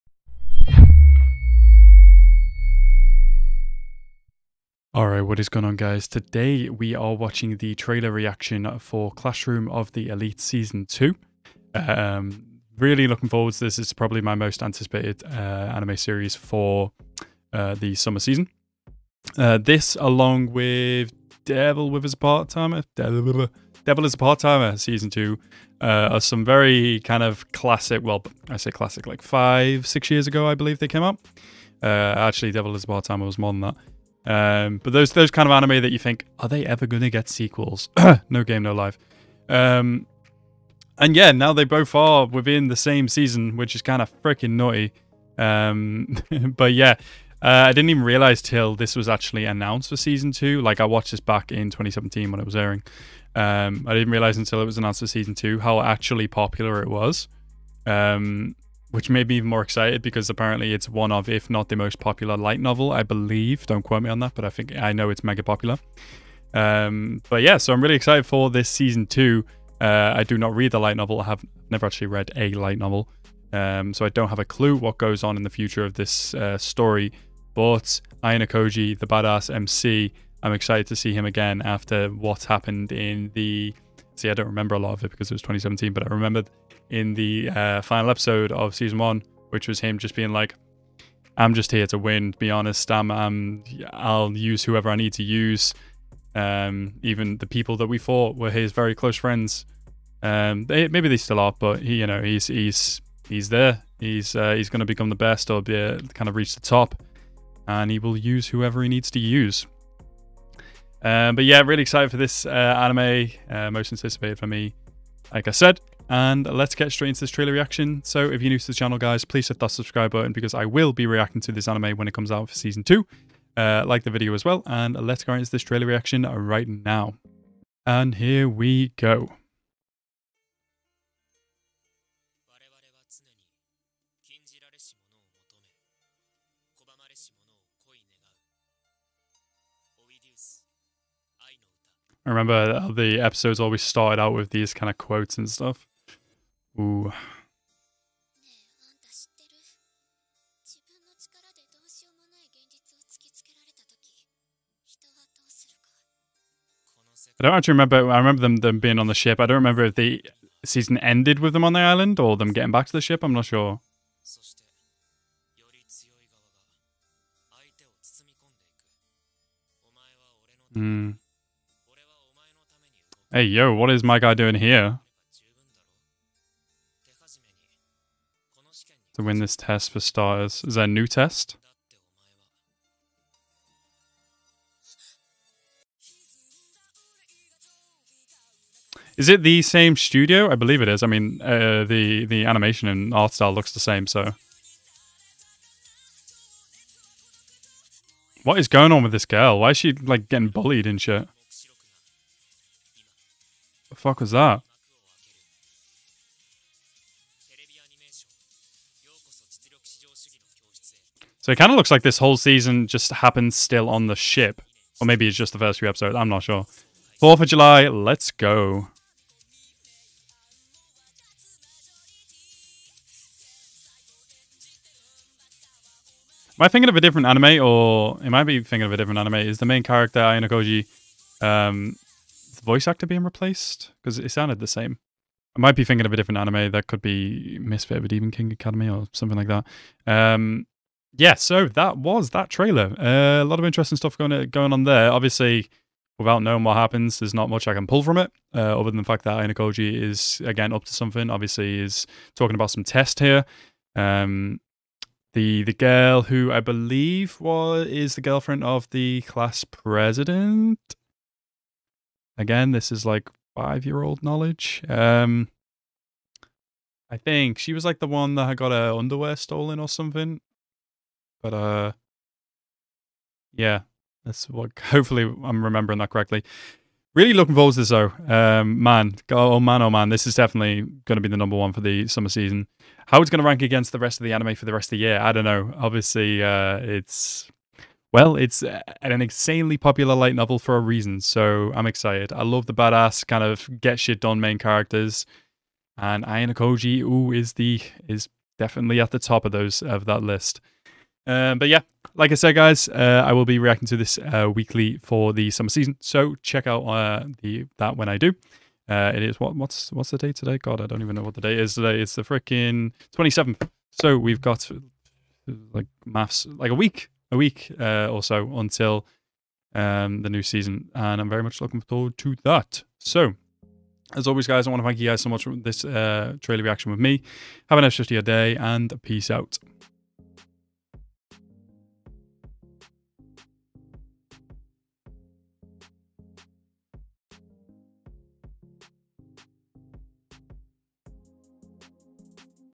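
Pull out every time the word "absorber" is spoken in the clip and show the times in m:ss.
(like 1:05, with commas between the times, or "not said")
not said.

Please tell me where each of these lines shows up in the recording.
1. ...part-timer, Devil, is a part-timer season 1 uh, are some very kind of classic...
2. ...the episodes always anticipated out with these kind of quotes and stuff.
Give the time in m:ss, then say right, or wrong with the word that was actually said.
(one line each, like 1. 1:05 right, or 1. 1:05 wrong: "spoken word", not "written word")
1. 0:22 wrong: "2", not "1"
2. 2:22 wrong: "started", not "anticipated".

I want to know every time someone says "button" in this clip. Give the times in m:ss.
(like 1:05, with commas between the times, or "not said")
2:00.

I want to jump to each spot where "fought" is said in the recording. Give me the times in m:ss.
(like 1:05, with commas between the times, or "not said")
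1:37.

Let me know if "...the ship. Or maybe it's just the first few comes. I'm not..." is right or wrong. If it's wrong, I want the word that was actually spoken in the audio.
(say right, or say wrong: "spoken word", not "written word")
wrong: "episodes", not "comes".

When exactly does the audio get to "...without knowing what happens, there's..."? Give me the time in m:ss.
4:06.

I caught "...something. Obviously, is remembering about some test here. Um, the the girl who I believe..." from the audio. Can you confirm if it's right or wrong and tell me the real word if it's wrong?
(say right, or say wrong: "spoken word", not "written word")
wrong: "talking", not "remembering".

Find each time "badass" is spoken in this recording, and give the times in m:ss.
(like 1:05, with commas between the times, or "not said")
1:19, 4:52.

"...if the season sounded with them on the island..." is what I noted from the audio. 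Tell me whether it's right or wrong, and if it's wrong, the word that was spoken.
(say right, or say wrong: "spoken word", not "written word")
wrong: "ended", not "sounded".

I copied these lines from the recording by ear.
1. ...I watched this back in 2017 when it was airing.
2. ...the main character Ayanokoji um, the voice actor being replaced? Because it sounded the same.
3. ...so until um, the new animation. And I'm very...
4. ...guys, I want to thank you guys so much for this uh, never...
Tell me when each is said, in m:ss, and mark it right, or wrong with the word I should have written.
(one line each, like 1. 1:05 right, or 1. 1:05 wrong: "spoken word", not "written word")
1. 0:50 right
2. 3:49 right
3. 5:18 wrong: "season", not "animation"
4. 5:24 wrong: "trailer", not "never".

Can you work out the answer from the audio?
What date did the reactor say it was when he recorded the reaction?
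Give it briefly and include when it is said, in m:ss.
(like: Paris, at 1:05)
27th, at 5:13.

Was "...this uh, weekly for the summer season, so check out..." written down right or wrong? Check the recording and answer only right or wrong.
right.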